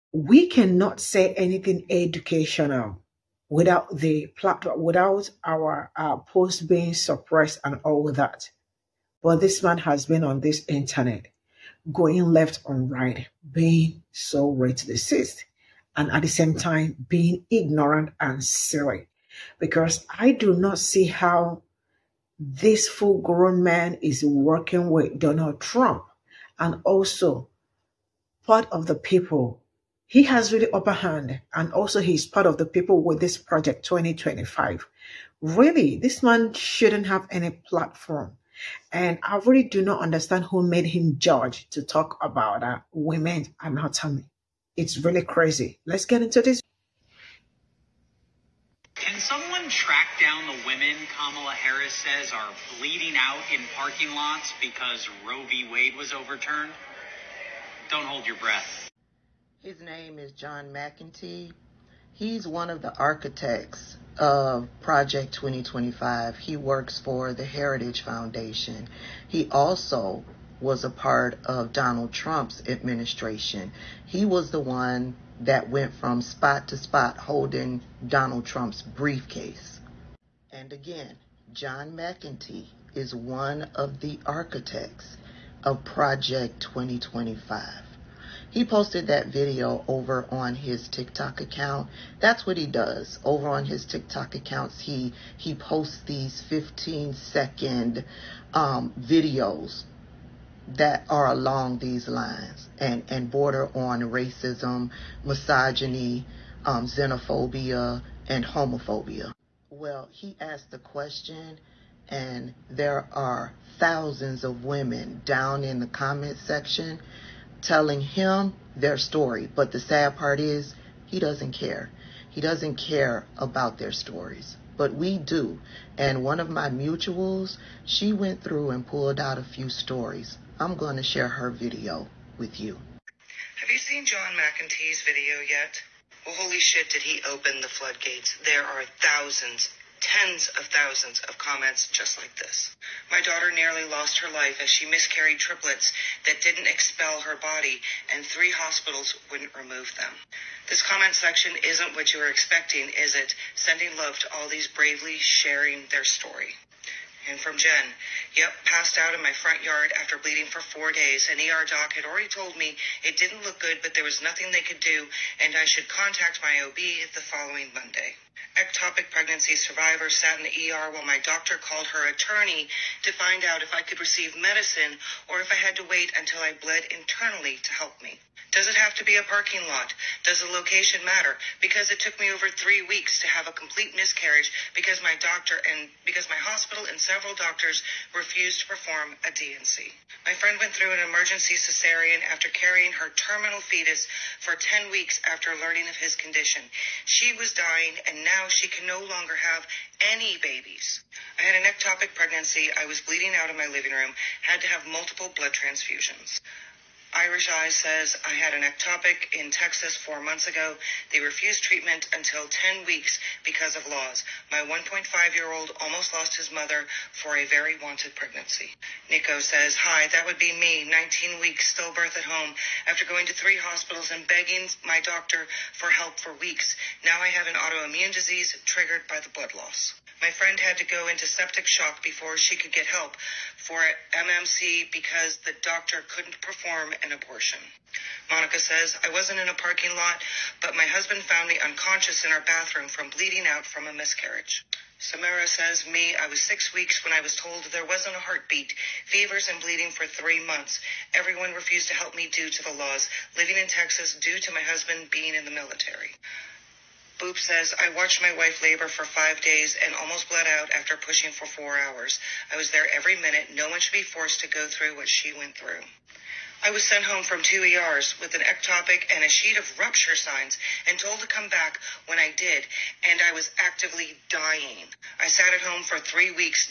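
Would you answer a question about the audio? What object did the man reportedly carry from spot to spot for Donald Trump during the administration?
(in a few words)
Briefcase.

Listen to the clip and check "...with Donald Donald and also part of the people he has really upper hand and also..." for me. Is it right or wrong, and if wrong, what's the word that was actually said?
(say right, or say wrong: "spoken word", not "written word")
wrong: "Trump", not "Donald".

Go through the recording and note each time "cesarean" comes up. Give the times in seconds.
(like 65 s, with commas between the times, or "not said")
191 s.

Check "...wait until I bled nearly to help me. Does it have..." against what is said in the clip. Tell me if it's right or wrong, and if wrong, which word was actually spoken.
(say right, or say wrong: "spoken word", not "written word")
wrong: "internally", not "nearly".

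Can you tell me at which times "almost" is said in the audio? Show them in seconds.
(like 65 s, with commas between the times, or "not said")
215 s, 260 s.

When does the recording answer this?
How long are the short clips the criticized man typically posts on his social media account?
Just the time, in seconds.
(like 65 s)
96 s.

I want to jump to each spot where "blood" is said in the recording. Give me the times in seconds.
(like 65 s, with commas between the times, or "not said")
205 s, 229 s.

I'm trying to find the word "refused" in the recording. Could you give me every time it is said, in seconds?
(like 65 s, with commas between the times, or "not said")
188 s, 211 s, 251 s.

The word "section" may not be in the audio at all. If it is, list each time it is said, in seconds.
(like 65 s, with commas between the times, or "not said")
116 s, 151 s.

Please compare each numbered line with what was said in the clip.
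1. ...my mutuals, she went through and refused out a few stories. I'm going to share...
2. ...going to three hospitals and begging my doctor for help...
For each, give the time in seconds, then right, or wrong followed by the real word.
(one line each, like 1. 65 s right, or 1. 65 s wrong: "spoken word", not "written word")
1. 126 s wrong: "pulled", not "refused"
2. 223 s right.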